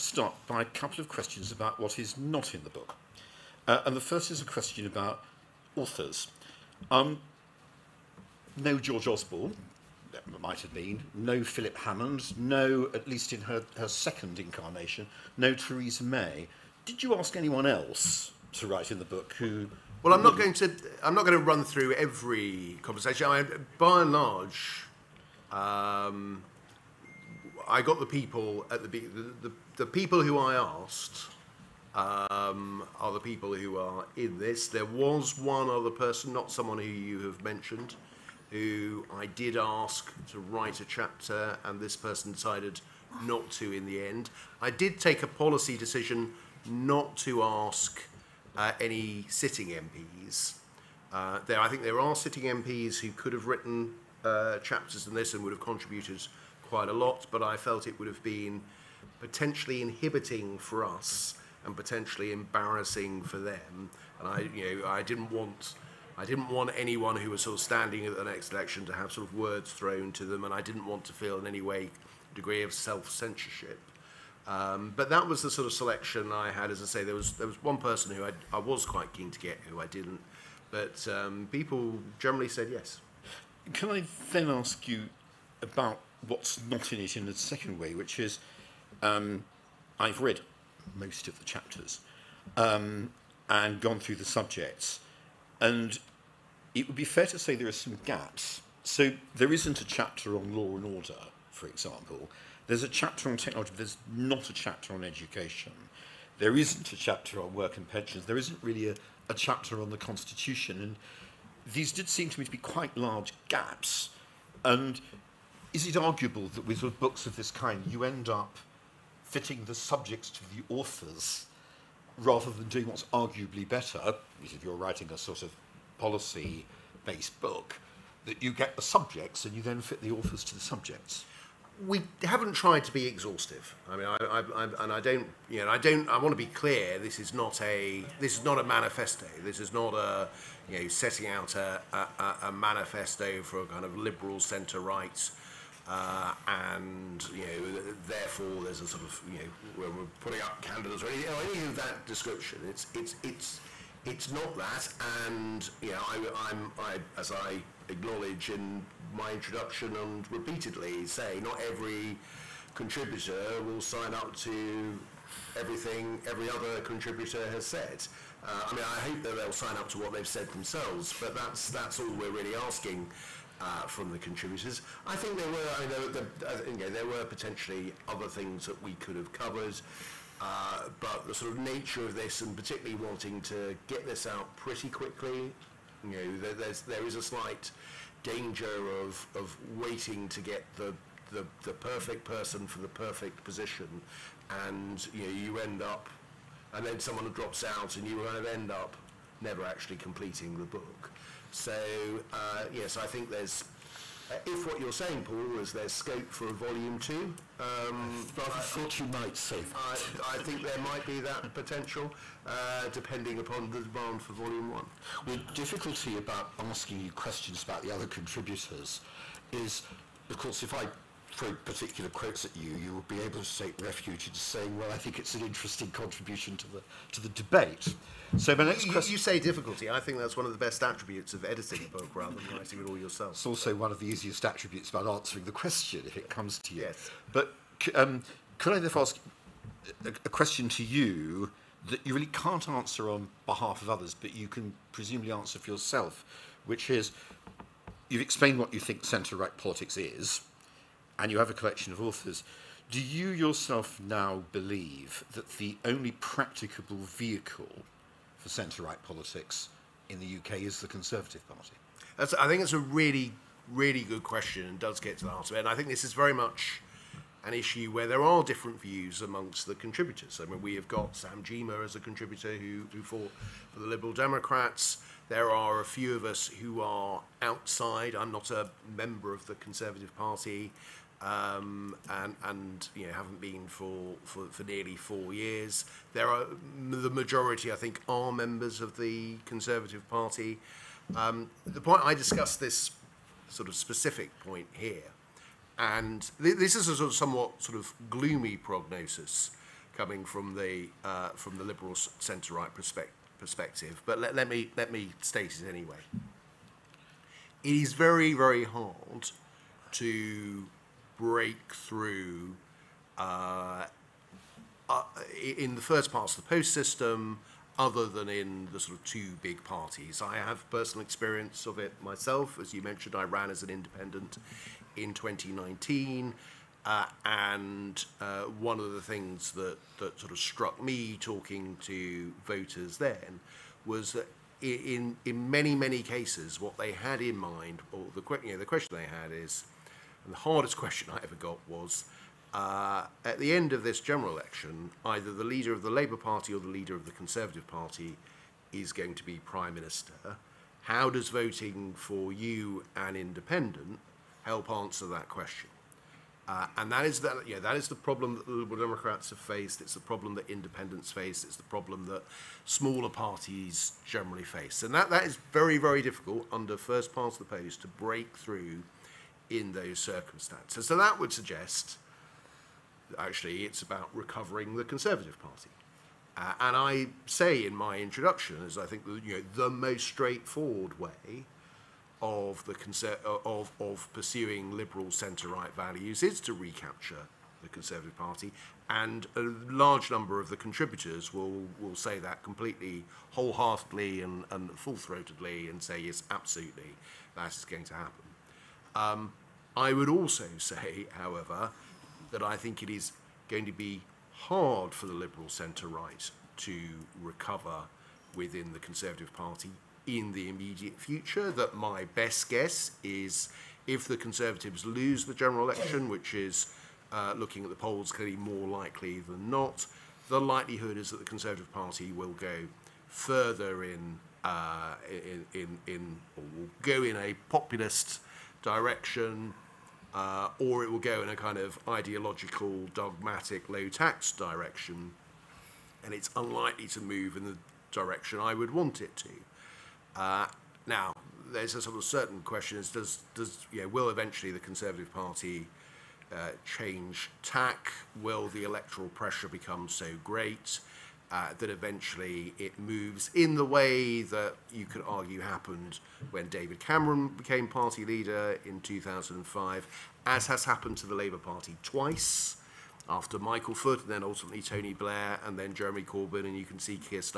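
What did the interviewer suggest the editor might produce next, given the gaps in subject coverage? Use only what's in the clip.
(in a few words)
Volume two.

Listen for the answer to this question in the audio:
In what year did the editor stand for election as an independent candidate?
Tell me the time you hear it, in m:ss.
5:25.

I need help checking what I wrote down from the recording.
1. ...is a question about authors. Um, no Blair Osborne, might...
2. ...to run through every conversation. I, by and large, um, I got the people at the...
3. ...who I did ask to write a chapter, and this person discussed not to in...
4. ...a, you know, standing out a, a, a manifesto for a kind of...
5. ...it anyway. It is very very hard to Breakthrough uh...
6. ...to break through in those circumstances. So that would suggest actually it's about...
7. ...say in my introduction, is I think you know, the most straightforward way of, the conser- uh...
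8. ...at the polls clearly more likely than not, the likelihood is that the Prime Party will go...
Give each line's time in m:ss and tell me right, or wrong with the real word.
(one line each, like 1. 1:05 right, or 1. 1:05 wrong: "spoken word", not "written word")
1. 0:04 wrong: "George", not "Blair"
2. 0:21 right
3. 0:38 wrong: "decided", not "discussed"
4. 2:19 wrong: "setting", not "standing"
5. 5:05 right
6. 6:07 right
7. 6:17 right
8. 6:57 wrong: "Conservative", not "Prime".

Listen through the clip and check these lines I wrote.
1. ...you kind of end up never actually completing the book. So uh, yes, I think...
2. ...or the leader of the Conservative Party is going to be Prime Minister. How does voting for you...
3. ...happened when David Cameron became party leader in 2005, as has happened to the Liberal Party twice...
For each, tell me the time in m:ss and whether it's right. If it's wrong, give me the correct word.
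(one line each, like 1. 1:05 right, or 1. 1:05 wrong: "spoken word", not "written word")
1. 3:18 right
2. 5:46 right
3. 7:35 wrong: "Labour", not "Liberal".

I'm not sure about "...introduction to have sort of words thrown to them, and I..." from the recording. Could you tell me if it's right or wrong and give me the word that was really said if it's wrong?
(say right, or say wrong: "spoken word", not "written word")
wrong: "election", not "introduction".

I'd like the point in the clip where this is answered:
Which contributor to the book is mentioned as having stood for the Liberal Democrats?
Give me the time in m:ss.
4:31.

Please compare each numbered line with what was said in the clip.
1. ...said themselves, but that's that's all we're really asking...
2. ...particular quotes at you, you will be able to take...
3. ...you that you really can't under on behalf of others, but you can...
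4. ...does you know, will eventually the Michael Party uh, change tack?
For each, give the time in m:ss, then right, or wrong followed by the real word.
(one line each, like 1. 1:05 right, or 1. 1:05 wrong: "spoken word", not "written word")
1. 2:50 right
2. 3:41 right
3. 4:00 wrong: "answer", not "under"
4. 7:23 wrong: "Conservative", not "Michael".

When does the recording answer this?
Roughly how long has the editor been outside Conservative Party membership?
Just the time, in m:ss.
4:44.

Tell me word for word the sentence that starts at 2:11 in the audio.
We haven't tried to be exhaustive.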